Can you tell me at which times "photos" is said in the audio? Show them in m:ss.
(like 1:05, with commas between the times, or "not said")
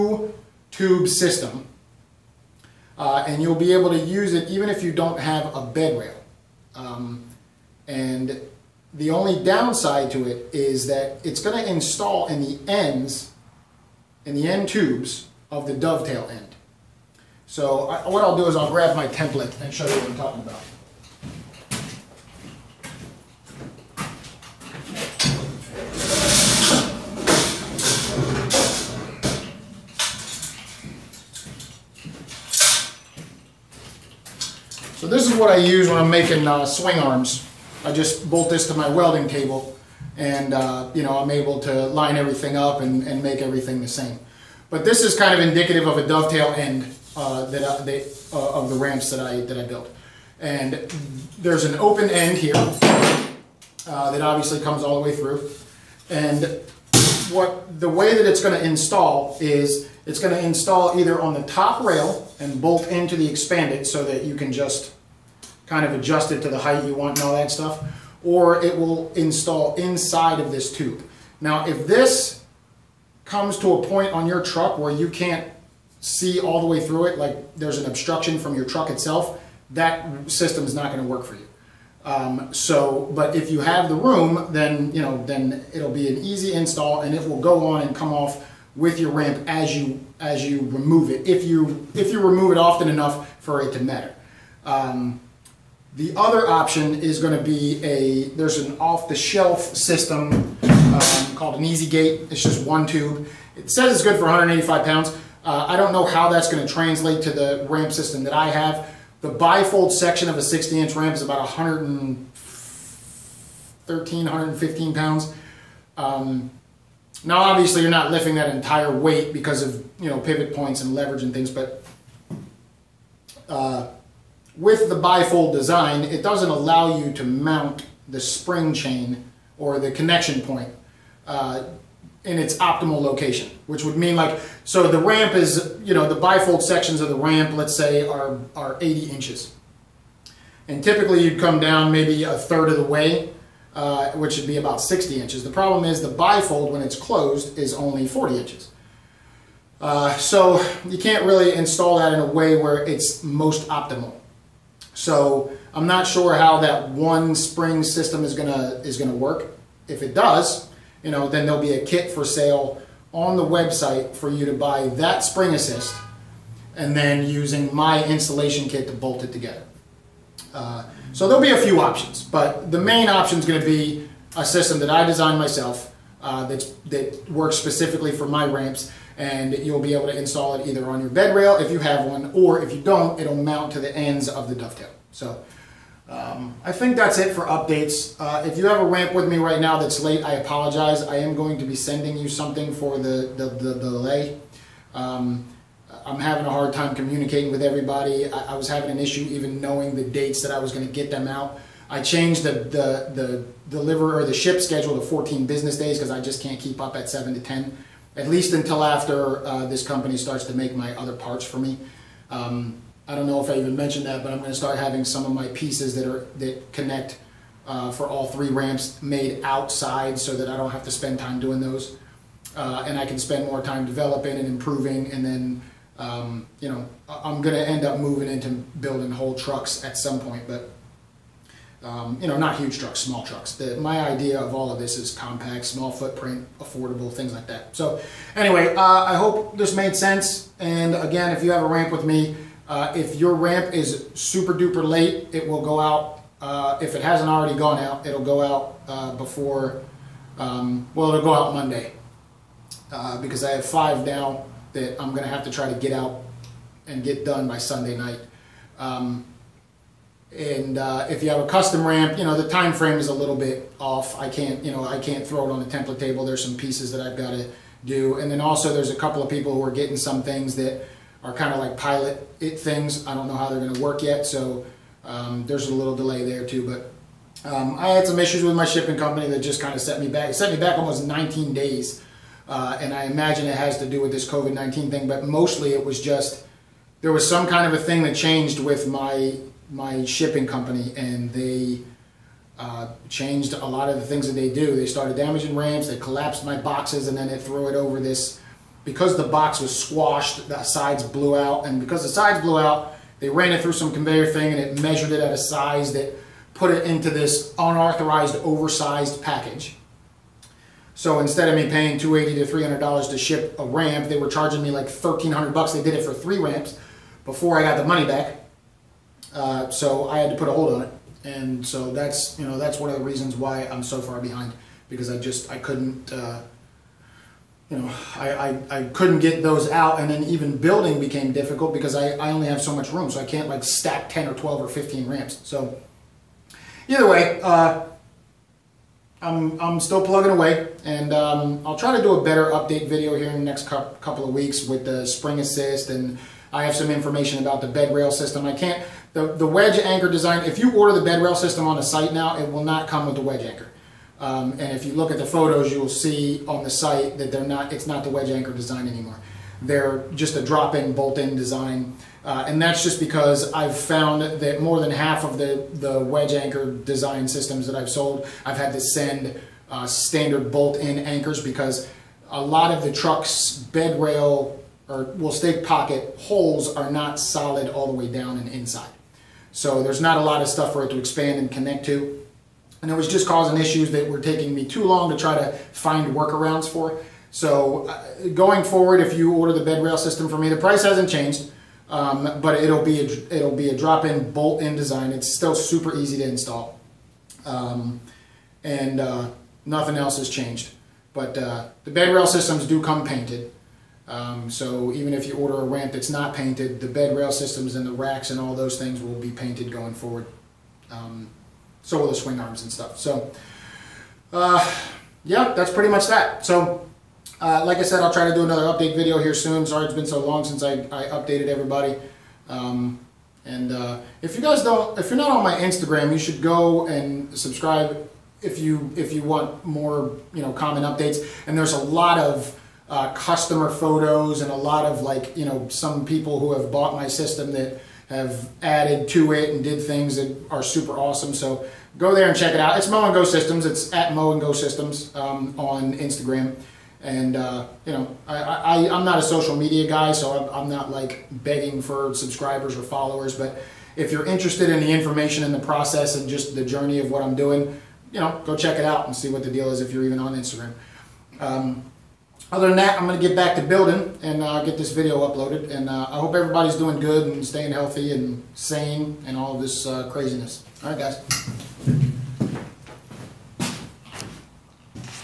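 5:55, 7:13.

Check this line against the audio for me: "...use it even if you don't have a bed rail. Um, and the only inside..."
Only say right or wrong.
wrong.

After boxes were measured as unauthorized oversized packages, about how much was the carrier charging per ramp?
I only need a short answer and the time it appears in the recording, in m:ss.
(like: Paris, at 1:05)
$1300, at 5:14.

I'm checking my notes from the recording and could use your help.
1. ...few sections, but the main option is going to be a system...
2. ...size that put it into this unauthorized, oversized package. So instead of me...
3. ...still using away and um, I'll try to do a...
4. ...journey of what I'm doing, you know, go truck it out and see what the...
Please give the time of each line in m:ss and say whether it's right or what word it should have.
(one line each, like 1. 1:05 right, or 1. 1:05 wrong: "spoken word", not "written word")
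1. 2:51 wrong: "options", not "sections"
2. 5:05 right
3. 5:39 wrong: "plugging", not "using"
4. 7:36 wrong: "check", not "truck".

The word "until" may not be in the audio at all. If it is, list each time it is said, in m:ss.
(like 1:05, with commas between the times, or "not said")
3:28.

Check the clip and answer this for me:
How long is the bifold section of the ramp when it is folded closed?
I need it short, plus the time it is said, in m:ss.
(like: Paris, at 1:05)
40 inches, at 2:28.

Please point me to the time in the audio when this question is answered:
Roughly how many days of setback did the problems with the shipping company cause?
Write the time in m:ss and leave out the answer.
4:41.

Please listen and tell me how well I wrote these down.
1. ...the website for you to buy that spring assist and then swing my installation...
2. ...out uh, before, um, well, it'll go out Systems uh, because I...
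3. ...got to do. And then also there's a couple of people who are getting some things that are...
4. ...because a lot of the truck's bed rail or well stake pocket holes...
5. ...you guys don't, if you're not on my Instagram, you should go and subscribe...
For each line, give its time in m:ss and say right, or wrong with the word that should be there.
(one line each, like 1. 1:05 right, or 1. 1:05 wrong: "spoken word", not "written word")
1. 2:43 wrong: "using", not "swing"
2. 4:08 wrong: "Monday", not "Systems"
3. 4:27 right
4. 6:11 right
5. 7:04 right.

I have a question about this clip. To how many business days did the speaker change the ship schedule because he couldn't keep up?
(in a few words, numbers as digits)
14.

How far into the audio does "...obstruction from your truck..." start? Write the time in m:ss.
1:17.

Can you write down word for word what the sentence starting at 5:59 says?
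They're just a drop-in, bolt-in design.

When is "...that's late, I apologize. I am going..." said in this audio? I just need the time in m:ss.
3:09.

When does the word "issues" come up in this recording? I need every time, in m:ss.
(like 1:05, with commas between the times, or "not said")
3:18, 4:38, 6:23.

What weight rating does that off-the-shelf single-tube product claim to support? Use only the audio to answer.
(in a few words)
185 pounds.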